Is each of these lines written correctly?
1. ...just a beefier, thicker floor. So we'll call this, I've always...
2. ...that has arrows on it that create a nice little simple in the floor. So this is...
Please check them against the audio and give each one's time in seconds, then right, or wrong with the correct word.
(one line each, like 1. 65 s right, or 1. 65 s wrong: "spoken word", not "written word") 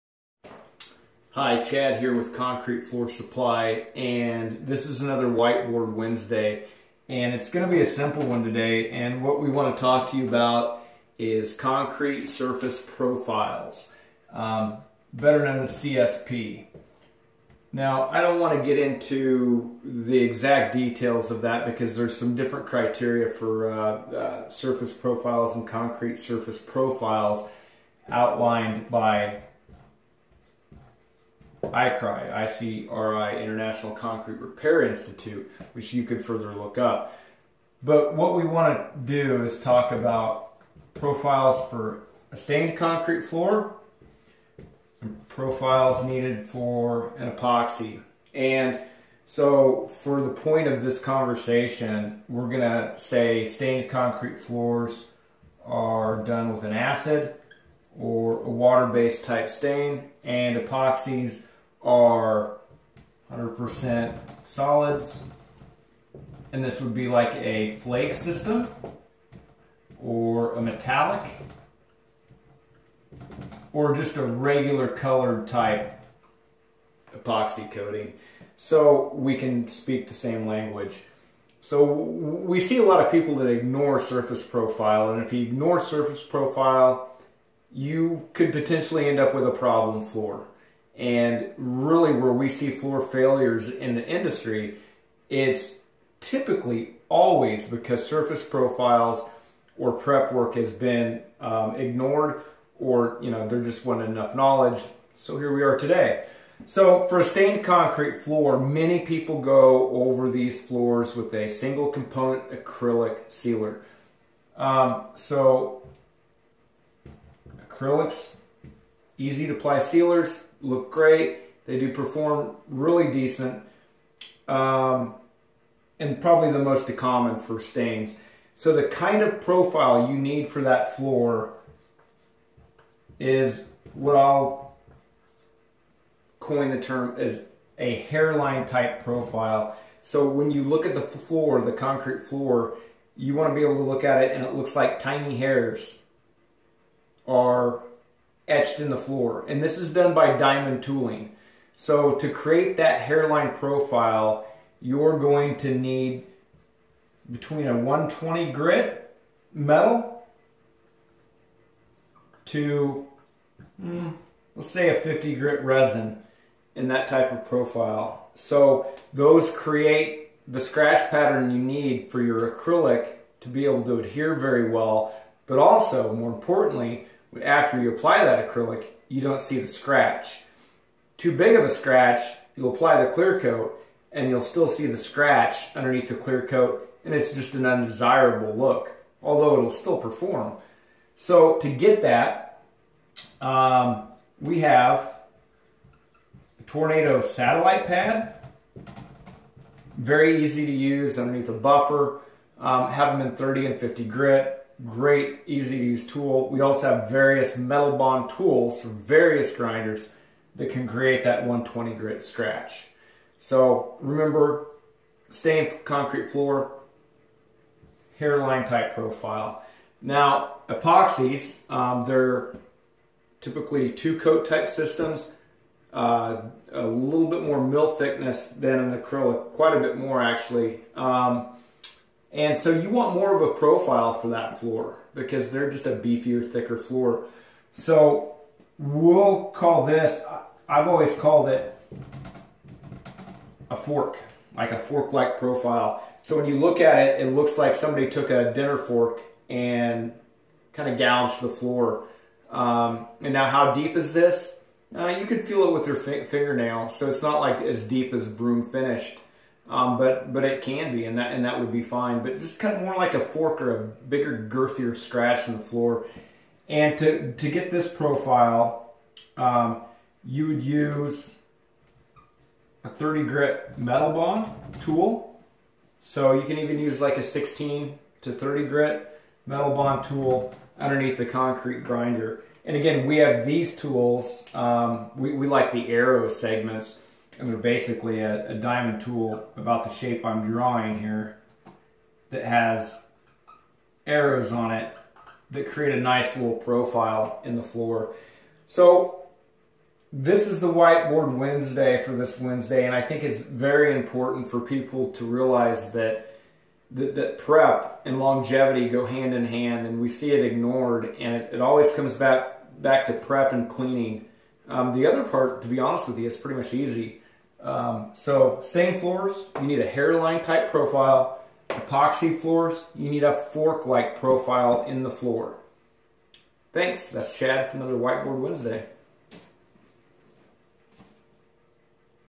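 1. 235 s right
2. 292 s wrong: "profile", not "simple".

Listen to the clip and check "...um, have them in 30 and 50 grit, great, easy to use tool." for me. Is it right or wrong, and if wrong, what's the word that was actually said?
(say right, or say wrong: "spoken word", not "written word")
right.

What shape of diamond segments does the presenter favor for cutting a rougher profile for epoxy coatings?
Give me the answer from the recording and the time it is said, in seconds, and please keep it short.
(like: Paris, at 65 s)
arrow segments, at 285 s.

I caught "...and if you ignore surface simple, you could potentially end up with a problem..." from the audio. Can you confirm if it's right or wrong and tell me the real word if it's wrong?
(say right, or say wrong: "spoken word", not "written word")
wrong: "profile", not "simple".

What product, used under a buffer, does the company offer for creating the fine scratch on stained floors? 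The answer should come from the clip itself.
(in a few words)
Tornado satellite pad.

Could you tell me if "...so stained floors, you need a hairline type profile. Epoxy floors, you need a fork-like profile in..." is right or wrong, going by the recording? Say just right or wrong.
right.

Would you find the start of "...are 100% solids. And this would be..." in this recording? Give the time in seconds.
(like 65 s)
61 s.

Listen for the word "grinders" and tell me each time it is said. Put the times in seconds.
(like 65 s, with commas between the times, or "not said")
209 s, 281 s.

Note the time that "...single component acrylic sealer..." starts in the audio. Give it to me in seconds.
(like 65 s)
111 s.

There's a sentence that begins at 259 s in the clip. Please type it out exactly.
Um, but but it can be, and that and that would be fine.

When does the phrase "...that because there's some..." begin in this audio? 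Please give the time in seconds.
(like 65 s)
21 s.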